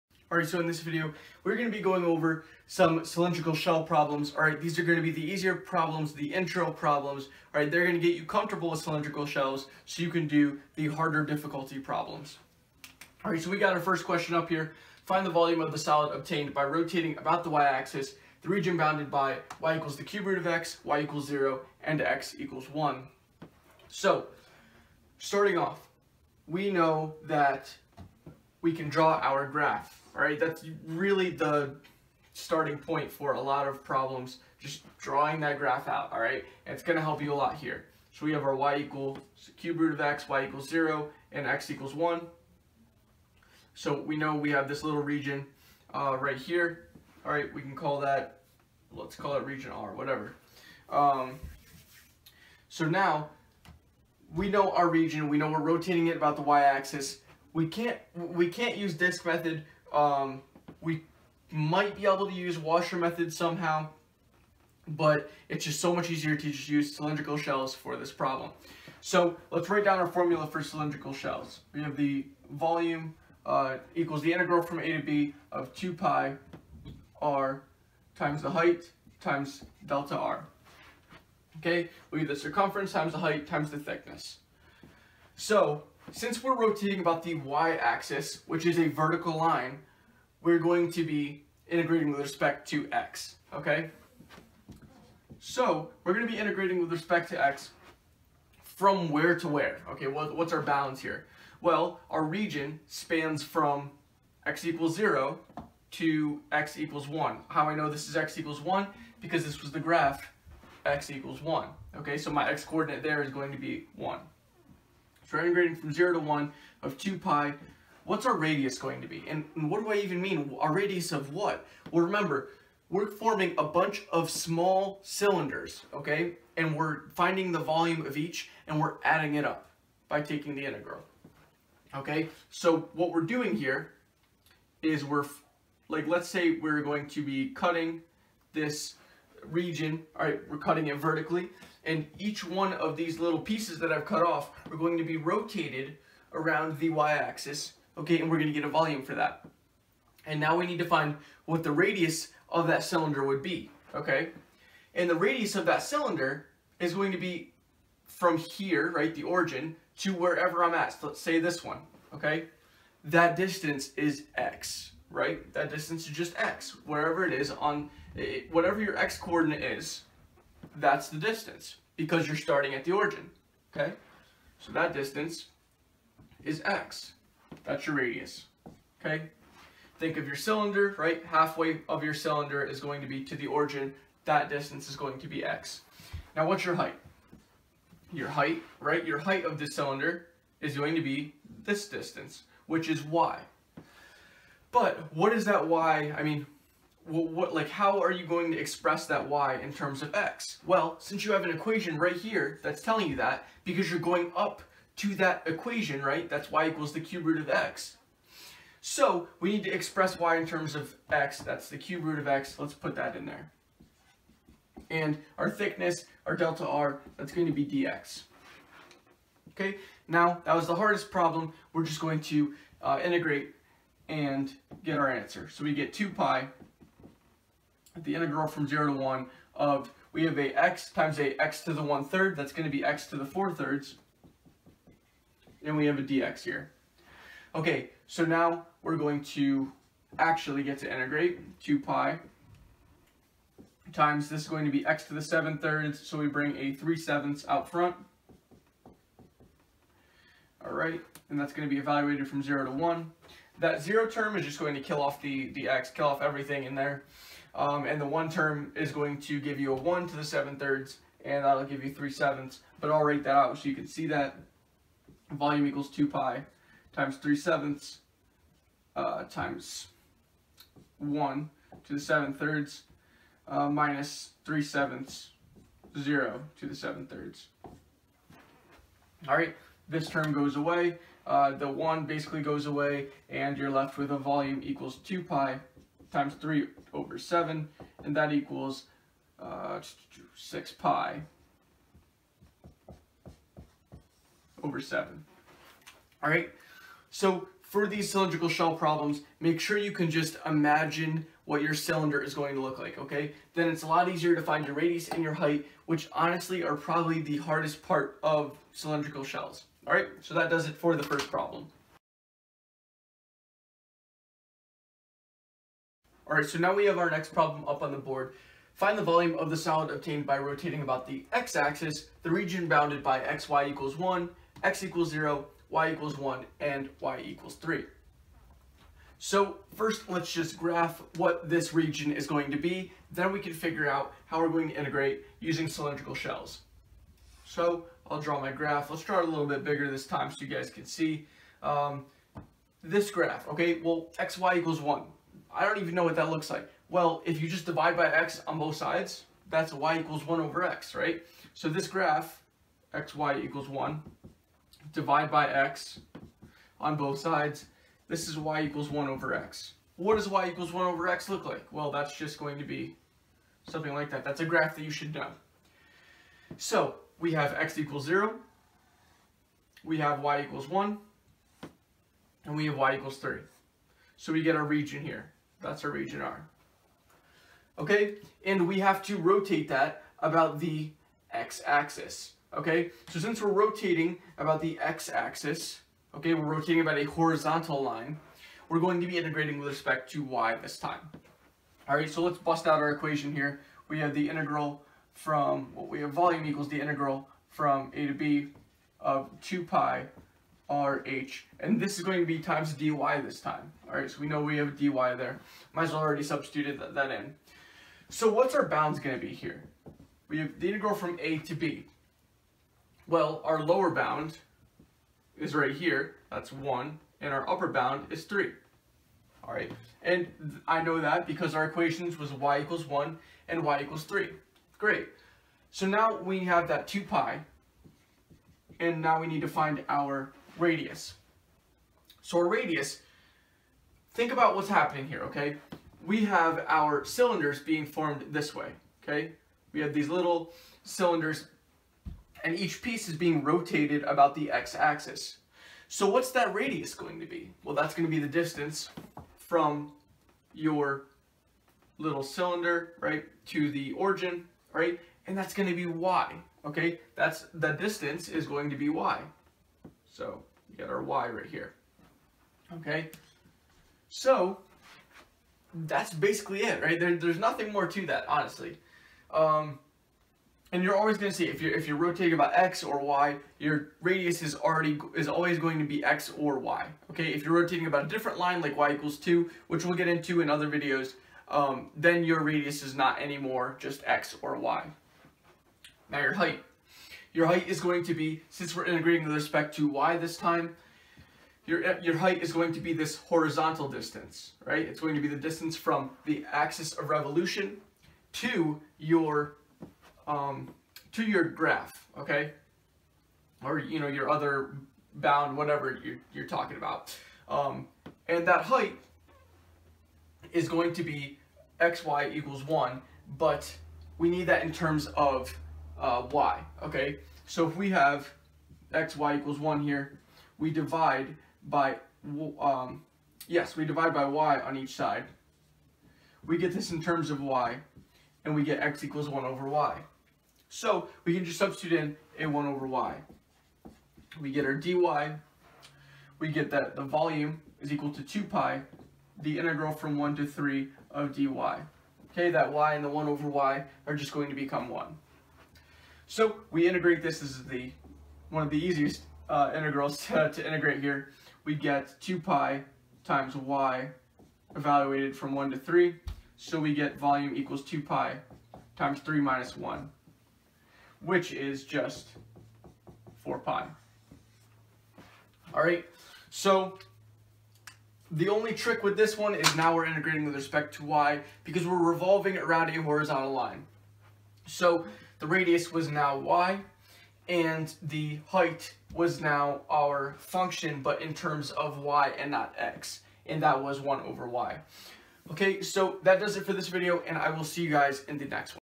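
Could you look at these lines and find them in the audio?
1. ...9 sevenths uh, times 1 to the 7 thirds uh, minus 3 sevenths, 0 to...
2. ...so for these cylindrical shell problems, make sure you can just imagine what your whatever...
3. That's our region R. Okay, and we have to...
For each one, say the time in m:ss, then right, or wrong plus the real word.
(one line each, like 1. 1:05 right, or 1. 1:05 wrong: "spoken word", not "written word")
1. 4:27 wrong: "3", not "9"
2. 4:57 wrong: "cylinder", not "whatever"
3. 6:15 right.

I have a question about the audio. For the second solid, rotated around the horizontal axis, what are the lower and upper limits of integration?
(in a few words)
1 and 3.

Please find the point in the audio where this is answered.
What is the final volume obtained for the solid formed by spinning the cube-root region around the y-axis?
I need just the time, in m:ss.
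4:50.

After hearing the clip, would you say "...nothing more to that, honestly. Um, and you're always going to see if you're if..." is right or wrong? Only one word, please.
right.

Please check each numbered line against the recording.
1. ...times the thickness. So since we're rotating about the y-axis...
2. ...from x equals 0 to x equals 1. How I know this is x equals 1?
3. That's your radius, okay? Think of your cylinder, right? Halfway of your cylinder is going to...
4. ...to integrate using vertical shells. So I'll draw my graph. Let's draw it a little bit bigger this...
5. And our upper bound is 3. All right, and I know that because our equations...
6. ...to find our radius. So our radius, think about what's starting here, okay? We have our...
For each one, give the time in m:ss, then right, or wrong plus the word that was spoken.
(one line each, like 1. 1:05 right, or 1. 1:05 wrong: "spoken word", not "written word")
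1. 1:23 right
2. 1:43 right
3. 2:57 right
4. 5:34 wrong: "cylindrical", not "vertical"
5. 6:57 right
6. 7:09 wrong: "happening", not "starting".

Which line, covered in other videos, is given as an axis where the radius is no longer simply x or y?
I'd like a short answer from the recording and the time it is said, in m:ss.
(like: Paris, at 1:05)
y = 2, at 7:58.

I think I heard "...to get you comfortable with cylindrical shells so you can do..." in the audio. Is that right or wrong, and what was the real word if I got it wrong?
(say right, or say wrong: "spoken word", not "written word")
right.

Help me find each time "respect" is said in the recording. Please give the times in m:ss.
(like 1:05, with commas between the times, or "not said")
1:32, 1:36, 6:29, 8:09, 9:30.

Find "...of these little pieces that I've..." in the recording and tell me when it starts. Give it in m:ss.
2:22.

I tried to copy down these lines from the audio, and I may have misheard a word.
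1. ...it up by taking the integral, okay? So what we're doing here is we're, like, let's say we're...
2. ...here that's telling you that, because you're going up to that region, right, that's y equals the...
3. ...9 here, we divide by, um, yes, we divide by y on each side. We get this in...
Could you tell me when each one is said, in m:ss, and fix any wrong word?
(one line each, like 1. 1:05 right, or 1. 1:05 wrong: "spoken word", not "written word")
1. 2:09 right
2. 3:22 wrong: "equation", not "region"
3. 8:39 wrong: "1", not "9".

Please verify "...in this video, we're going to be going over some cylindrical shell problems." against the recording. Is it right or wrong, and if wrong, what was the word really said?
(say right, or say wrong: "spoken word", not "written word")
right.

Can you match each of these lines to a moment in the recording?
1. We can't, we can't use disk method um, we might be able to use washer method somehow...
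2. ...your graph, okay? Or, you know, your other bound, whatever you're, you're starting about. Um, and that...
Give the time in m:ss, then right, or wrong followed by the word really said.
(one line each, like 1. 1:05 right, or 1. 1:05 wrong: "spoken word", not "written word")
1. 0:57 right
2. 8:21 wrong: "talking", not "starting".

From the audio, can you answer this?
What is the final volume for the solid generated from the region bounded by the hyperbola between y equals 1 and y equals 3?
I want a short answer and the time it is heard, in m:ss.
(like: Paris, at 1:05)
4 pi, at 9:23.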